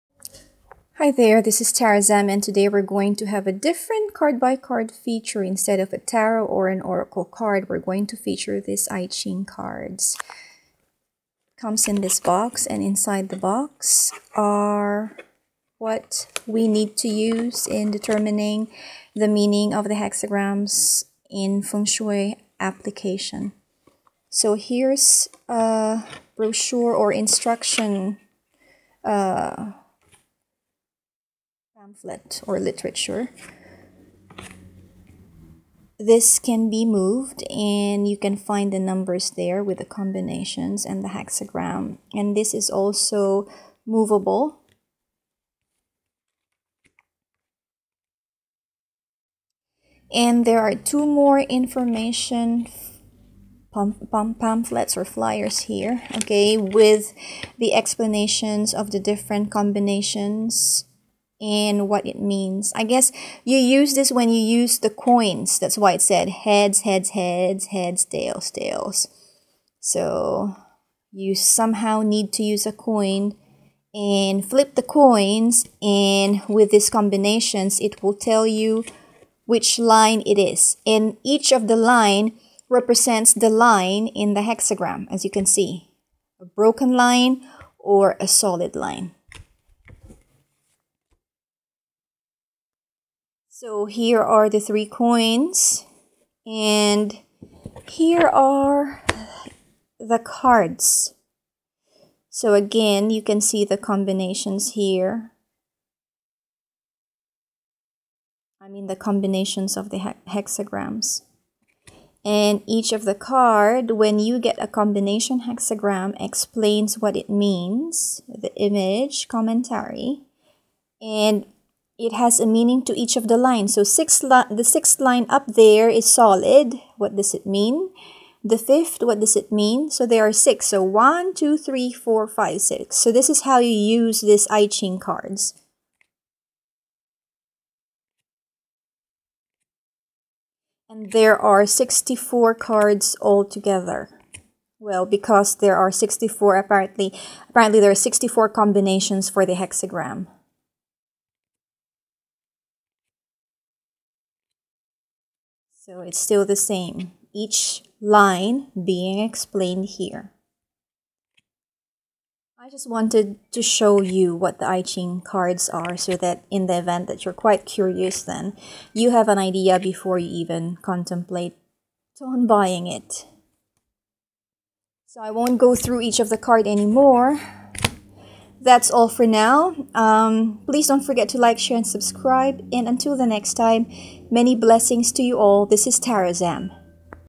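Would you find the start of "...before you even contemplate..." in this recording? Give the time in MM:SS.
02:49.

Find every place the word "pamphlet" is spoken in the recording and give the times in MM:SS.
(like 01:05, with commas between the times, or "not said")
00:31, 00:53.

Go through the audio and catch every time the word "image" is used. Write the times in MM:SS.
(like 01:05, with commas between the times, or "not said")
01:58.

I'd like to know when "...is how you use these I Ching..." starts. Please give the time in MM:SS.
02:13.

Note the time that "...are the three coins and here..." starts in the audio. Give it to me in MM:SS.
01:34.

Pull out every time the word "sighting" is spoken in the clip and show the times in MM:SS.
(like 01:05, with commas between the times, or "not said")
not said.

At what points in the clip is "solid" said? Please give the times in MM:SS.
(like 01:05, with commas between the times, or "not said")
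01:28, 02:06.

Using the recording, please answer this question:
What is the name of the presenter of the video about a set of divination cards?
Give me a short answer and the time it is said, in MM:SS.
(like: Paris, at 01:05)
Tara, at 00:01.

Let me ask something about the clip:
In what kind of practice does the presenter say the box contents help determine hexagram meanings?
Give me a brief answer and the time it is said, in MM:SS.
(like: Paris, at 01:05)
feng shui, at 00:21.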